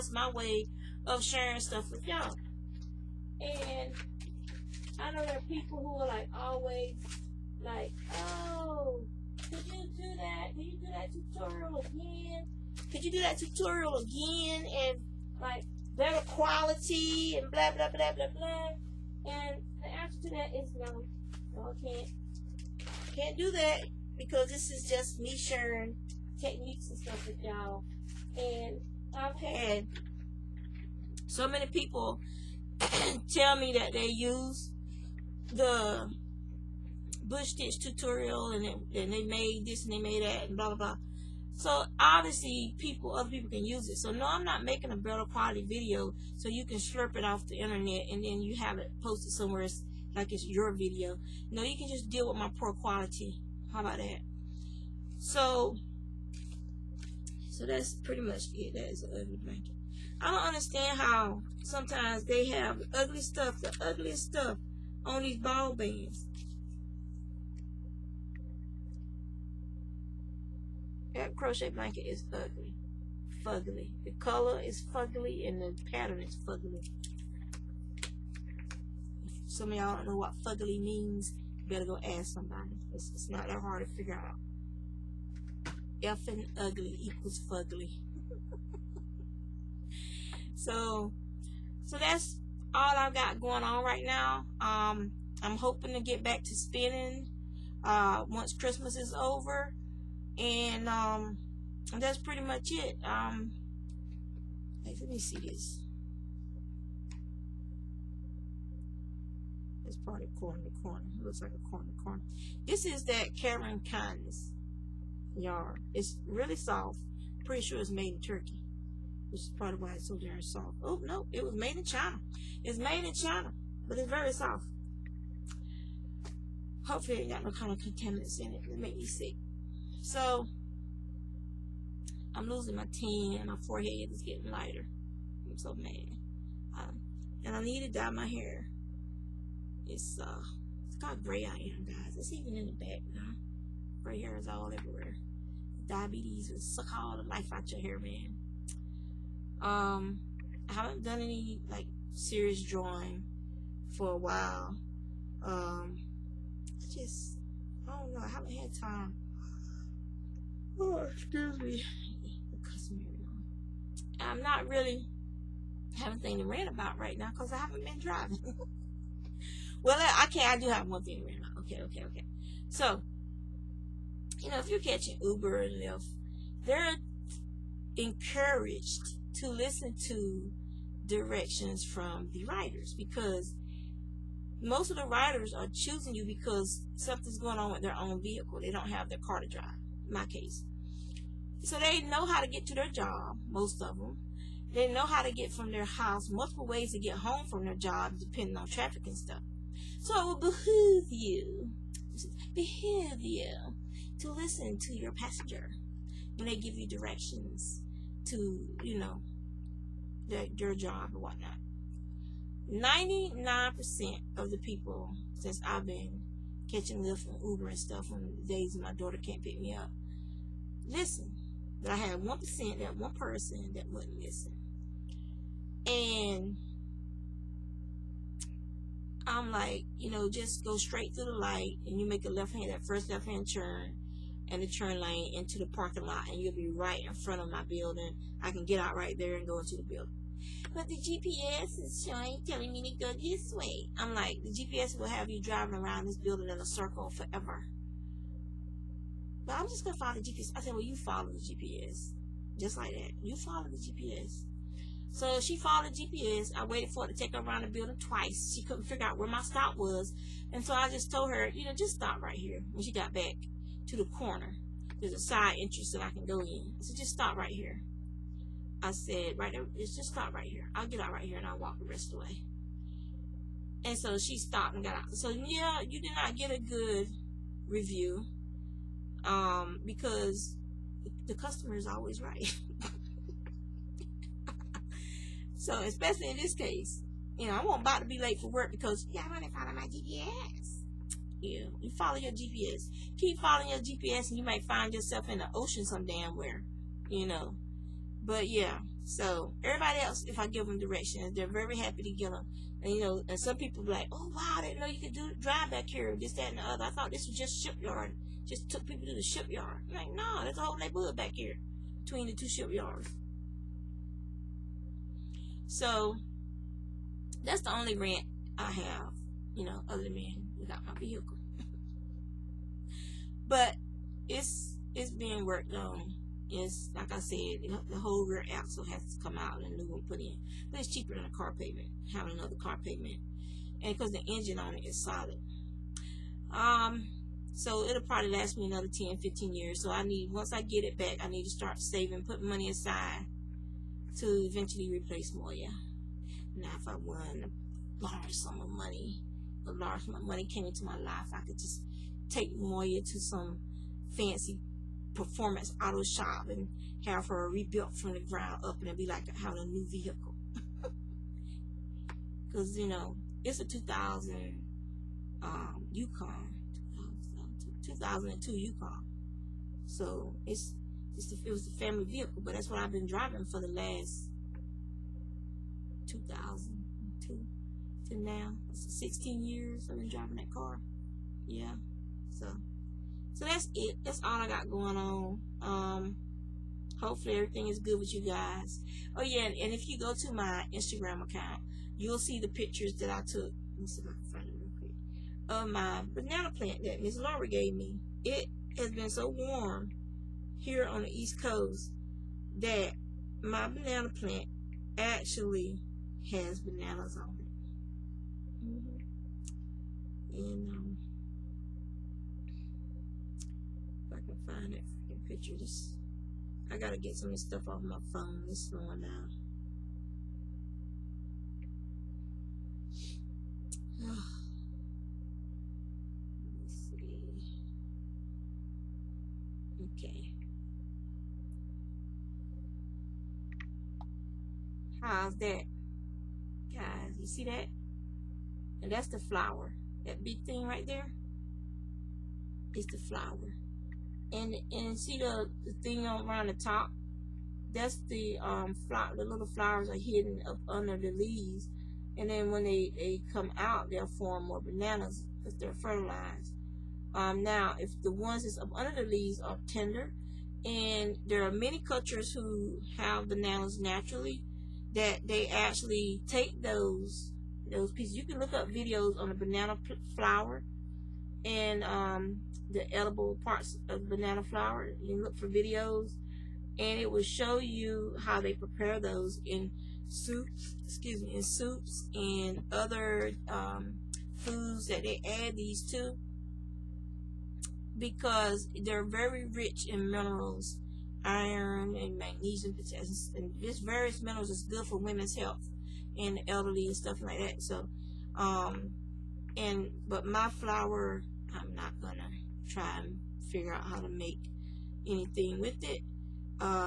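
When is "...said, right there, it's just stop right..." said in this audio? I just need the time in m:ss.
4:28.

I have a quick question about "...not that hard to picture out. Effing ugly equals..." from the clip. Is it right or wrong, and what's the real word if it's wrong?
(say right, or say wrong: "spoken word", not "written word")
wrong: "figure", not "picture".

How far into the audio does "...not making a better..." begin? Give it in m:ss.
0:44.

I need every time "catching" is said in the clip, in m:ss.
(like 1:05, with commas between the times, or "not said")
2:54, 3:36.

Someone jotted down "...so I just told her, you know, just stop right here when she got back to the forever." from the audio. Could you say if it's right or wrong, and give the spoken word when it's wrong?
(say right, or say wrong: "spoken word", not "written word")
wrong: "corner", not "forever".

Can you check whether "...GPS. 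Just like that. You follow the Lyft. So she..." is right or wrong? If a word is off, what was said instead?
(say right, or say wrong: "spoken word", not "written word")
wrong: "GPS", not "Lyft".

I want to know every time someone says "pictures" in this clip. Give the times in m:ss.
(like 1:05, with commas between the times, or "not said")
6:32, 6:55.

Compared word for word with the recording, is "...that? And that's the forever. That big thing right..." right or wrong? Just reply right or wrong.
wrong.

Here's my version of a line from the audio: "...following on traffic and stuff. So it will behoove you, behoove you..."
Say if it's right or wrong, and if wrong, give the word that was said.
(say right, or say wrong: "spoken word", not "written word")
wrong: "depending", not "following".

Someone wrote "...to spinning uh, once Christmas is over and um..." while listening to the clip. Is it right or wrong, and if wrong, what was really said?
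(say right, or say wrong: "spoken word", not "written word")
right.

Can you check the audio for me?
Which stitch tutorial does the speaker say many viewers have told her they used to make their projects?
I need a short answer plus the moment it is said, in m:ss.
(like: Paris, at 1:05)
bush stitch, at 0:37.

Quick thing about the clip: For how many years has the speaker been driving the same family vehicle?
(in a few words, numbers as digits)
16.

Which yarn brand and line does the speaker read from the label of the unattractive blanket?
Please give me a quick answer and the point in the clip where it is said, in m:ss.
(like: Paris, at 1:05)
Caron Kindness, at 1:53.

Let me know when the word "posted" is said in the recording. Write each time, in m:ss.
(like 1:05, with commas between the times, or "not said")
0:49.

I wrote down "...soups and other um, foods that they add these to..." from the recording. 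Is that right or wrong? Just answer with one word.
right.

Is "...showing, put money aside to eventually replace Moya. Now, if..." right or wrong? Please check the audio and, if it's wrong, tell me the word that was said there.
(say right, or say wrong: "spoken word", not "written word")
wrong: "saving", not "showing".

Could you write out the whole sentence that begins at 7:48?
You can look up videos on the banana flower and um, the edible parts of banana flower.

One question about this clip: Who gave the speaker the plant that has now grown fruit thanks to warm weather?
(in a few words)
Miss Laura.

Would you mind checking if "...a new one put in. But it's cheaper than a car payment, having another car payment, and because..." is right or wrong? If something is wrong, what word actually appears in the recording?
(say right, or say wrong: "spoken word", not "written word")
right.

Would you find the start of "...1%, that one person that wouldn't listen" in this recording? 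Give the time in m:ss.
3:42.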